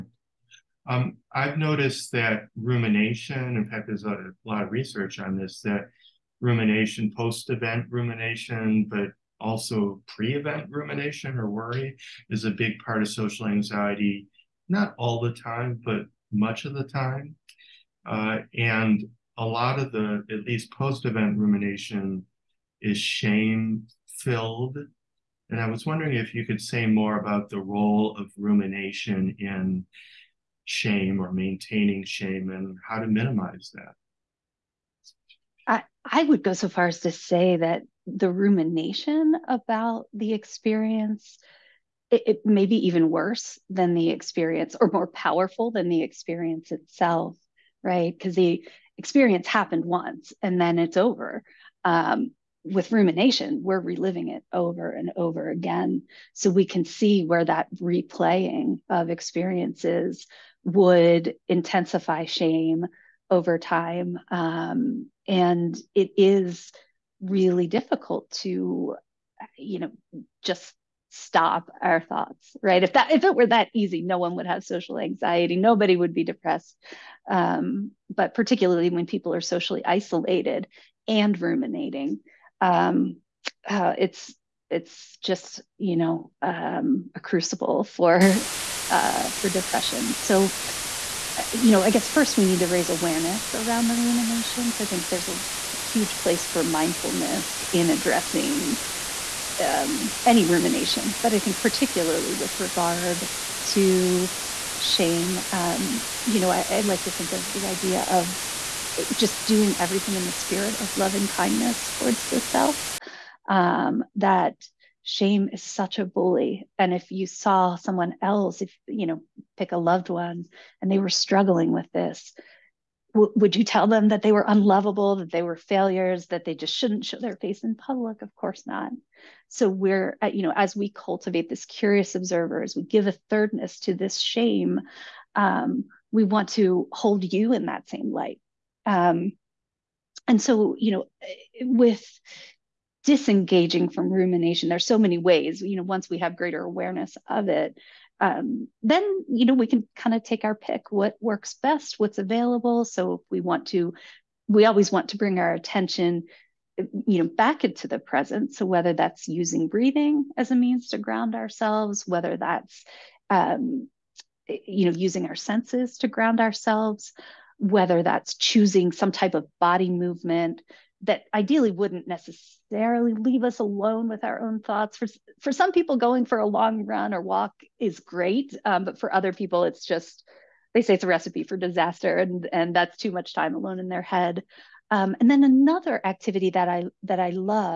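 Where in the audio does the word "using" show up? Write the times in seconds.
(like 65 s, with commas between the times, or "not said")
159 s, 164 s.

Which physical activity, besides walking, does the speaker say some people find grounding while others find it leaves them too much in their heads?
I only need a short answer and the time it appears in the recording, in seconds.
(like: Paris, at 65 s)
a long run, at 176 s.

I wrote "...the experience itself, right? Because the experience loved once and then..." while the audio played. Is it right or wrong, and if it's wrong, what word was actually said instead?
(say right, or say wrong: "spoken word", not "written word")
wrong: "happened", not "loved".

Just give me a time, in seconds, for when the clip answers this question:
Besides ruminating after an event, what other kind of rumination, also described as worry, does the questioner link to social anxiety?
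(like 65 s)
10 s.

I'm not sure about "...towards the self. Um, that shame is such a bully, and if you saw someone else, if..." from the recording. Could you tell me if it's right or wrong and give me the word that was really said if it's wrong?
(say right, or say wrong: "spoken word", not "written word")
right.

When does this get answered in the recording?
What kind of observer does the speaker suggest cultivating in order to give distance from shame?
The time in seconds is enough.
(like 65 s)
131 s.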